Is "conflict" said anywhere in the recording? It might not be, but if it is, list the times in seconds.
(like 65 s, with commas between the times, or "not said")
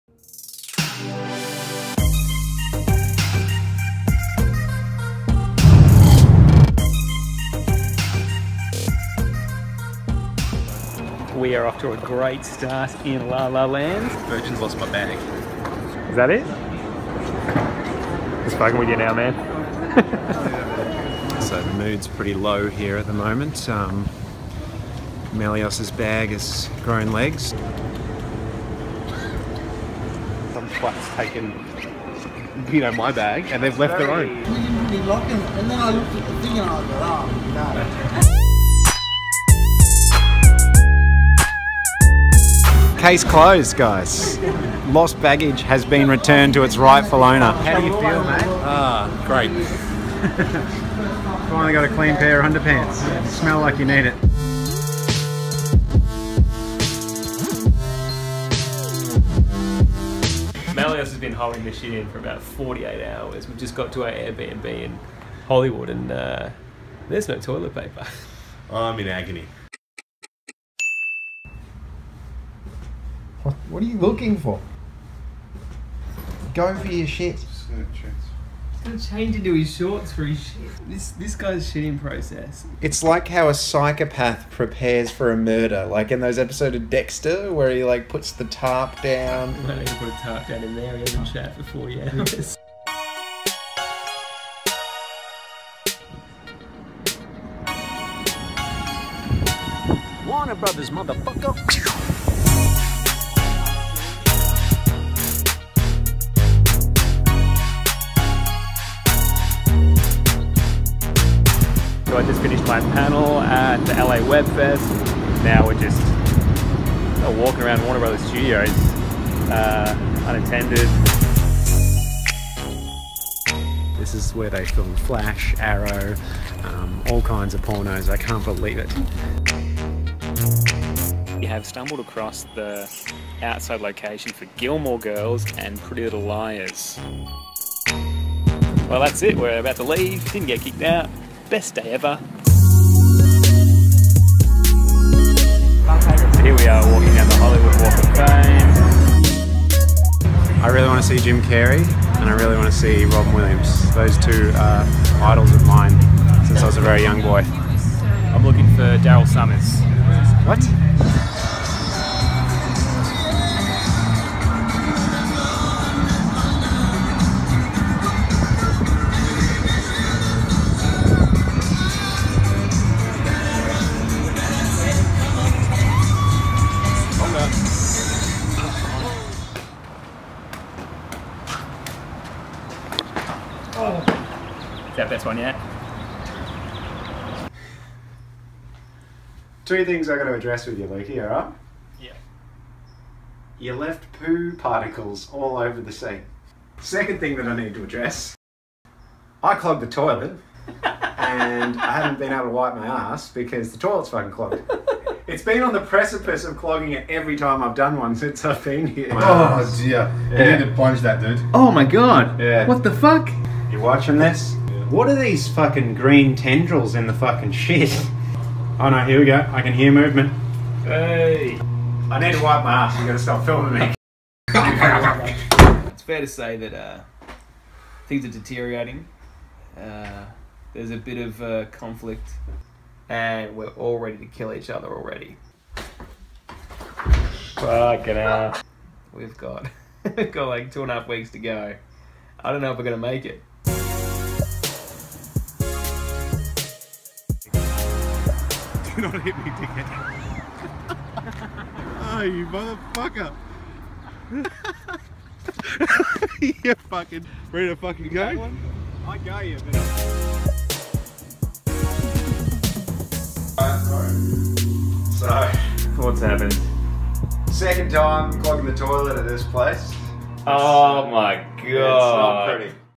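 231 s.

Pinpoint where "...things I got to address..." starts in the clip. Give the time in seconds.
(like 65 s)
189 s.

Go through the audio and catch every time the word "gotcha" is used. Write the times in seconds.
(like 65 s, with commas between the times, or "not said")
not said.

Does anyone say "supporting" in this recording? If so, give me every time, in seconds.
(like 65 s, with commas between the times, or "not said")
not said.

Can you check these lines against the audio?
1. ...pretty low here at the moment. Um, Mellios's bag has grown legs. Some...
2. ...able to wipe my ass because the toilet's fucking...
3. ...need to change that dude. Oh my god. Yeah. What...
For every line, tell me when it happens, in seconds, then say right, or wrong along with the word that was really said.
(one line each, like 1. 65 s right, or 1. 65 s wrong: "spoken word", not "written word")
1. 22 s right
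2. 202 s right
3. 210 s wrong: "plunge", not "change".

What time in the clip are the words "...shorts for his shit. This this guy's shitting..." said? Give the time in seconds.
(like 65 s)
79 s.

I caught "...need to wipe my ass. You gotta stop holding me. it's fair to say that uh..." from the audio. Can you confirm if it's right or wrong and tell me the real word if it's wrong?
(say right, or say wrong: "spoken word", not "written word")
wrong: "filming", not "holding".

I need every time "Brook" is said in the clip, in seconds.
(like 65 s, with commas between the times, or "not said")
not said.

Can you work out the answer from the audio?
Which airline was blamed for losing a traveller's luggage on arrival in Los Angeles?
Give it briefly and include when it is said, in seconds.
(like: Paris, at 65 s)
Virgin, at 14 s.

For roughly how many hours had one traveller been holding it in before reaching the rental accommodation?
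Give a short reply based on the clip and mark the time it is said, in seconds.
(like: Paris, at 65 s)
48, at 62 s.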